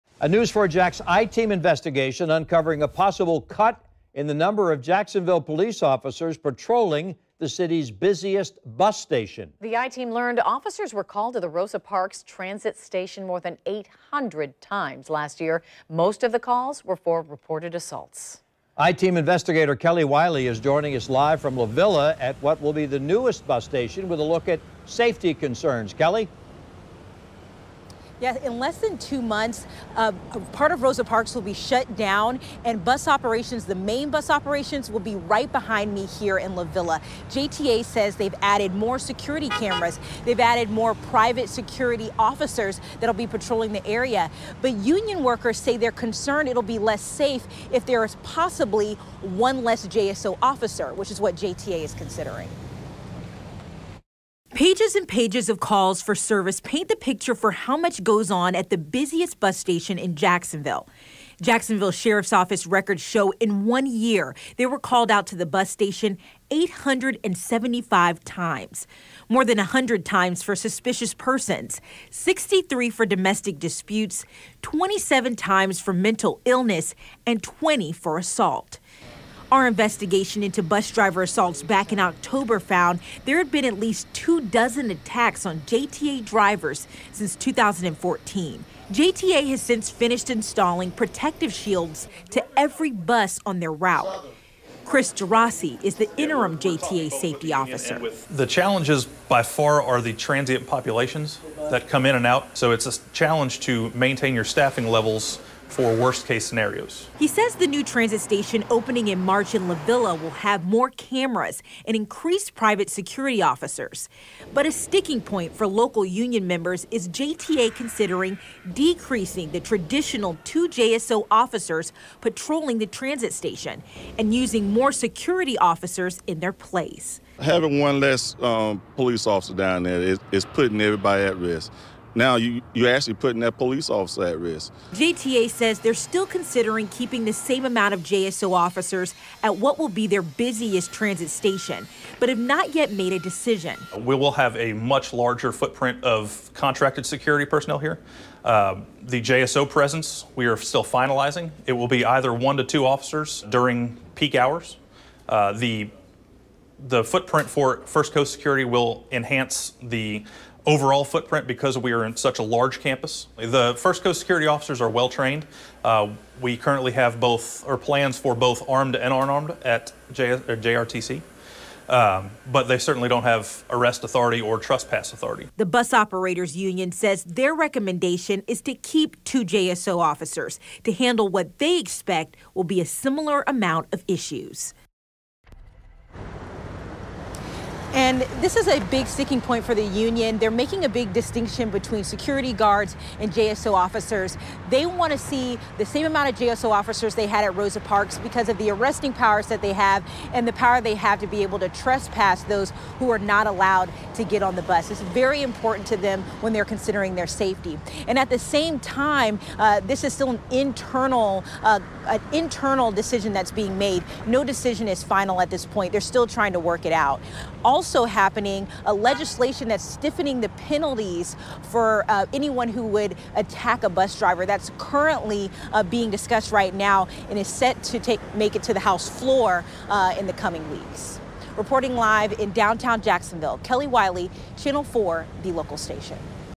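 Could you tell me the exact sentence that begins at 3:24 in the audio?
It's very important to them when they're considering their safety.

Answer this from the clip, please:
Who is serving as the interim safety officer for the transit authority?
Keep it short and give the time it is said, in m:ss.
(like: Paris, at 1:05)
Chris DeRossi, at 1:34.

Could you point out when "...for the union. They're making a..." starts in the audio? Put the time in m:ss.
3:09.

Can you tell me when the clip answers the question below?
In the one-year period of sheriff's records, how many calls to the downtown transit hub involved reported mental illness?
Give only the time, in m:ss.
1:14.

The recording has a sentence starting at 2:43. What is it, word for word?
The First Coast security officers are well trained.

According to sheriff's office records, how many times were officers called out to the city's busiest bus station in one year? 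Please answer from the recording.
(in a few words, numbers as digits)
875.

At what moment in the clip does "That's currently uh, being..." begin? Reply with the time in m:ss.
3:44.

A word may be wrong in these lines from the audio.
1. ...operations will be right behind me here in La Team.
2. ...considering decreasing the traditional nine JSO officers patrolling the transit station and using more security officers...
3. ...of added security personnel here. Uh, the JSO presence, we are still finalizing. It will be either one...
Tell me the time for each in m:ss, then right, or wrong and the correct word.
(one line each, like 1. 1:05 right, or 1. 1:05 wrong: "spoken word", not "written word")
1. 0:34 wrong: "Villa", not "Team"
2. 1:57 wrong: "two", not "nine"
3. 2:26 wrong: "contracted", not "added".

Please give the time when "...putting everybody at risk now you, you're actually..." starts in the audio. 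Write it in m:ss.
2:10.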